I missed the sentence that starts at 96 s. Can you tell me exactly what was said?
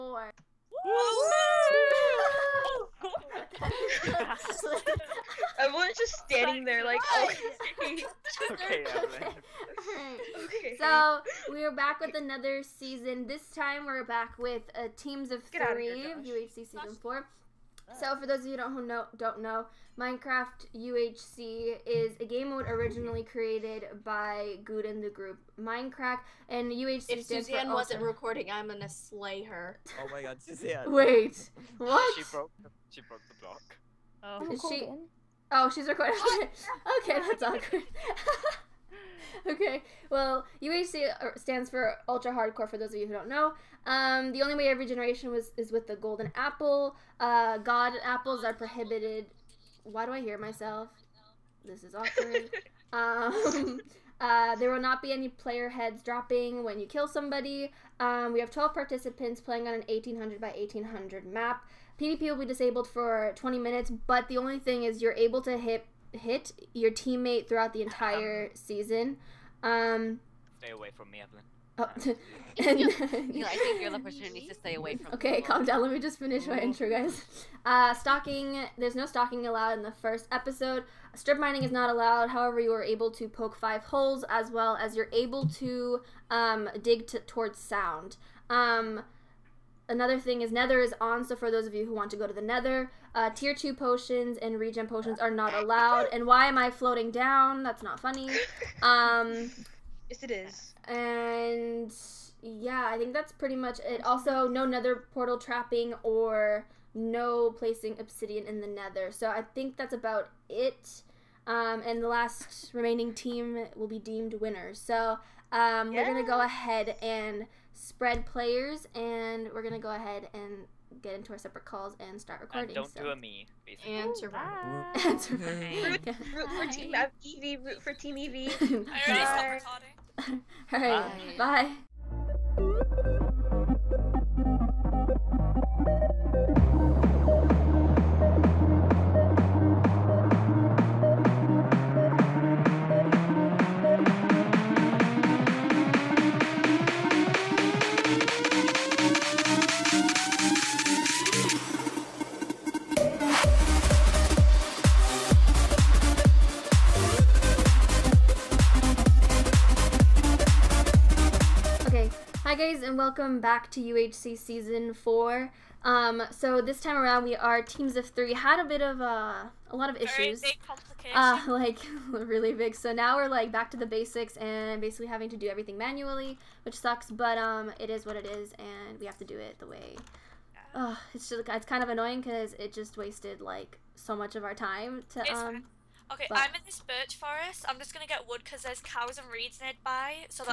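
And why am I floating down?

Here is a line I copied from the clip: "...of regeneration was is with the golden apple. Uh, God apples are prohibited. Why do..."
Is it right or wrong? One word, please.
right.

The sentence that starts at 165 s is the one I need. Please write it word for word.
Um, so this time around, we are teams of three.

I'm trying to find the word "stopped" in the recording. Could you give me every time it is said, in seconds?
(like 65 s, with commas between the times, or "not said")
129 s.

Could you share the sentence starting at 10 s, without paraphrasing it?
So we are back with another season.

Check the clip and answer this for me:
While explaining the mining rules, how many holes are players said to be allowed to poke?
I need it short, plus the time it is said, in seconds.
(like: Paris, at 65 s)
5, at 83 s.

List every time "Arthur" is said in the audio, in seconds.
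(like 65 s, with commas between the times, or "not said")
not said.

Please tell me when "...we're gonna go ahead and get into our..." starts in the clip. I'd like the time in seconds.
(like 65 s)
119 s.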